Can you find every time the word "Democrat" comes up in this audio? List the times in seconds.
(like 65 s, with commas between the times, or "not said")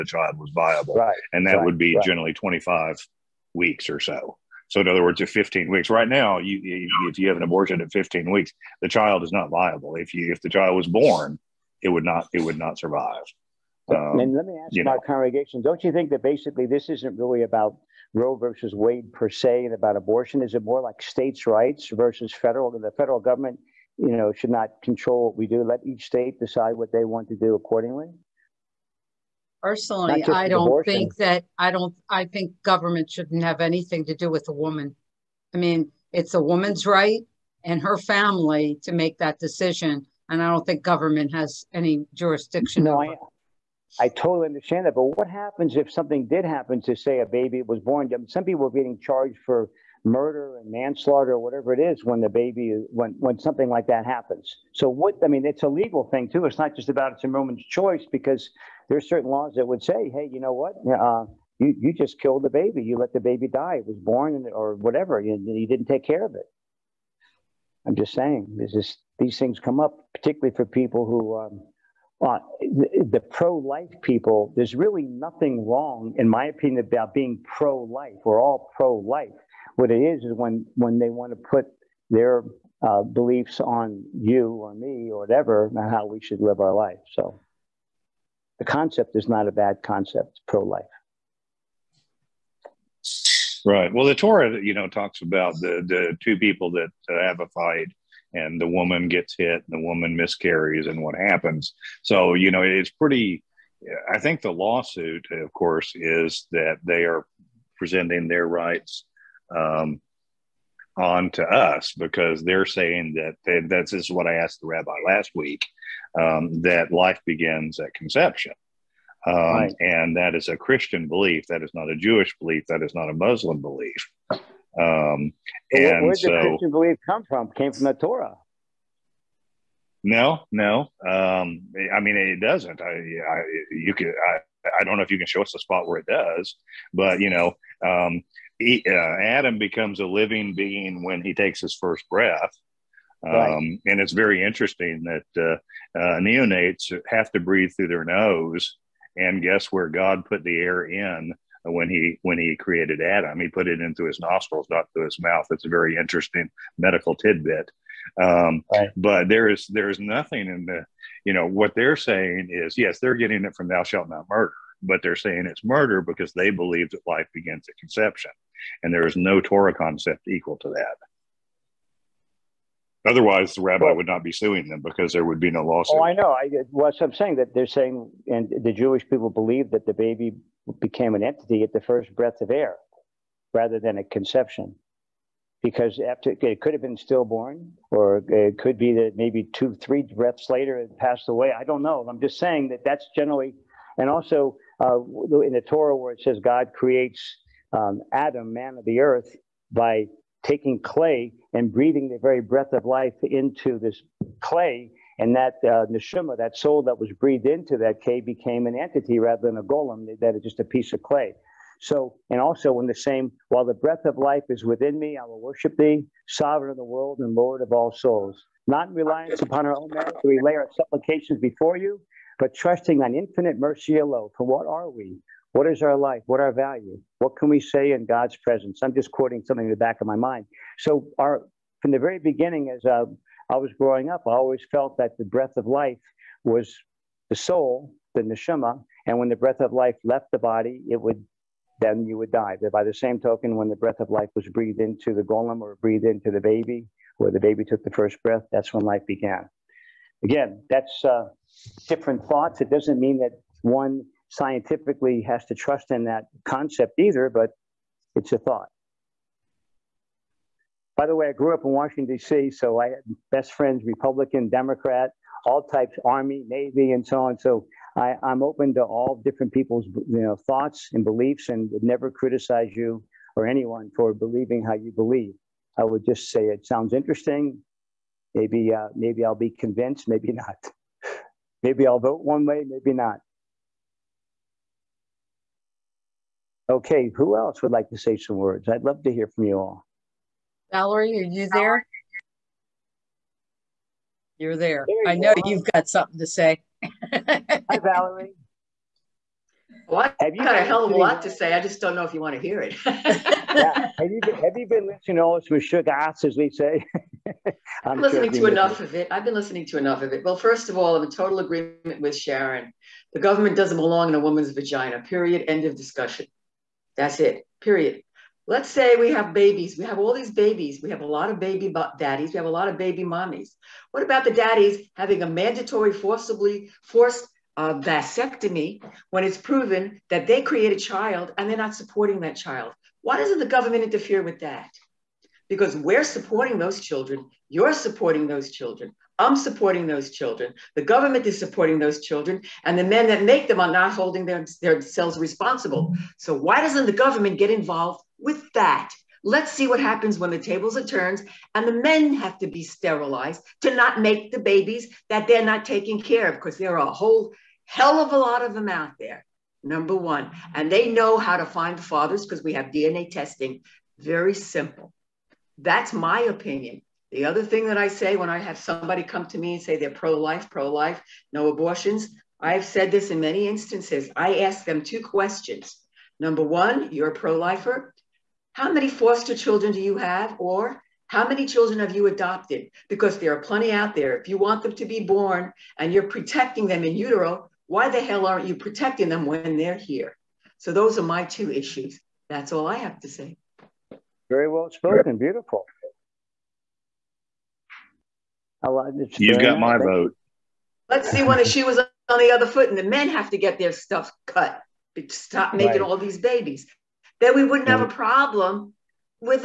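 264 s.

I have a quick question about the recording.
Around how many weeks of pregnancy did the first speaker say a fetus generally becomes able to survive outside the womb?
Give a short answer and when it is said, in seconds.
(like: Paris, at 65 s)
25 weeks, at 2 s.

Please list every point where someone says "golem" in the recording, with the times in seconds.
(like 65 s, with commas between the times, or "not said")
209 s, 245 s.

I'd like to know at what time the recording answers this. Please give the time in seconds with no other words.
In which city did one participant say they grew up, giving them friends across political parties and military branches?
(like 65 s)
261 s.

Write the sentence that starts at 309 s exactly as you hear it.
I've been listening to enough of it.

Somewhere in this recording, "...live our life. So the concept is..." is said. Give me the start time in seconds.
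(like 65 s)
86 s.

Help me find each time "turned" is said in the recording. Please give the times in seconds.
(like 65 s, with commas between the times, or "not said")
350 s.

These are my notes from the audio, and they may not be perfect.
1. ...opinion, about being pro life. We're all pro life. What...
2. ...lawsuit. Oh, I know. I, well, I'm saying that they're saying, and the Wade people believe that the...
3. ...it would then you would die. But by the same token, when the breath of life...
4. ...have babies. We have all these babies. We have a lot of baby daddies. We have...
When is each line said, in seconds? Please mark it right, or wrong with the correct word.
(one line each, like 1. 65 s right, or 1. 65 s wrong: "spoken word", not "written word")
1. 76 s right
2. 175 s wrong: "Jewish", not "Wade"
3. 240 s right
4. 319 s right.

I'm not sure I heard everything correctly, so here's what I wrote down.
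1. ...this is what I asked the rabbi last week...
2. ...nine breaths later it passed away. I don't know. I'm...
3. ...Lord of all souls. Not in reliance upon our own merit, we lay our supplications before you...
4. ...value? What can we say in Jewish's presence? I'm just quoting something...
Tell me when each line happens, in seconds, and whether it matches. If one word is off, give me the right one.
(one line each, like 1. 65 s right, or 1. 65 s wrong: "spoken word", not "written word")
1. 113 s right
2. 189 s wrong: "three", not "nine"
3. 217 s right
4. 226 s wrong: "God", not "Jewish".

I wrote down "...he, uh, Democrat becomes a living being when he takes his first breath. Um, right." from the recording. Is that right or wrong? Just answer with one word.
wrong.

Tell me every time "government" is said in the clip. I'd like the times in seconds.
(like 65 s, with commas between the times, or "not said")
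23 s, 32 s, 40 s, 313 s, 333 s, 340 s, 346 s.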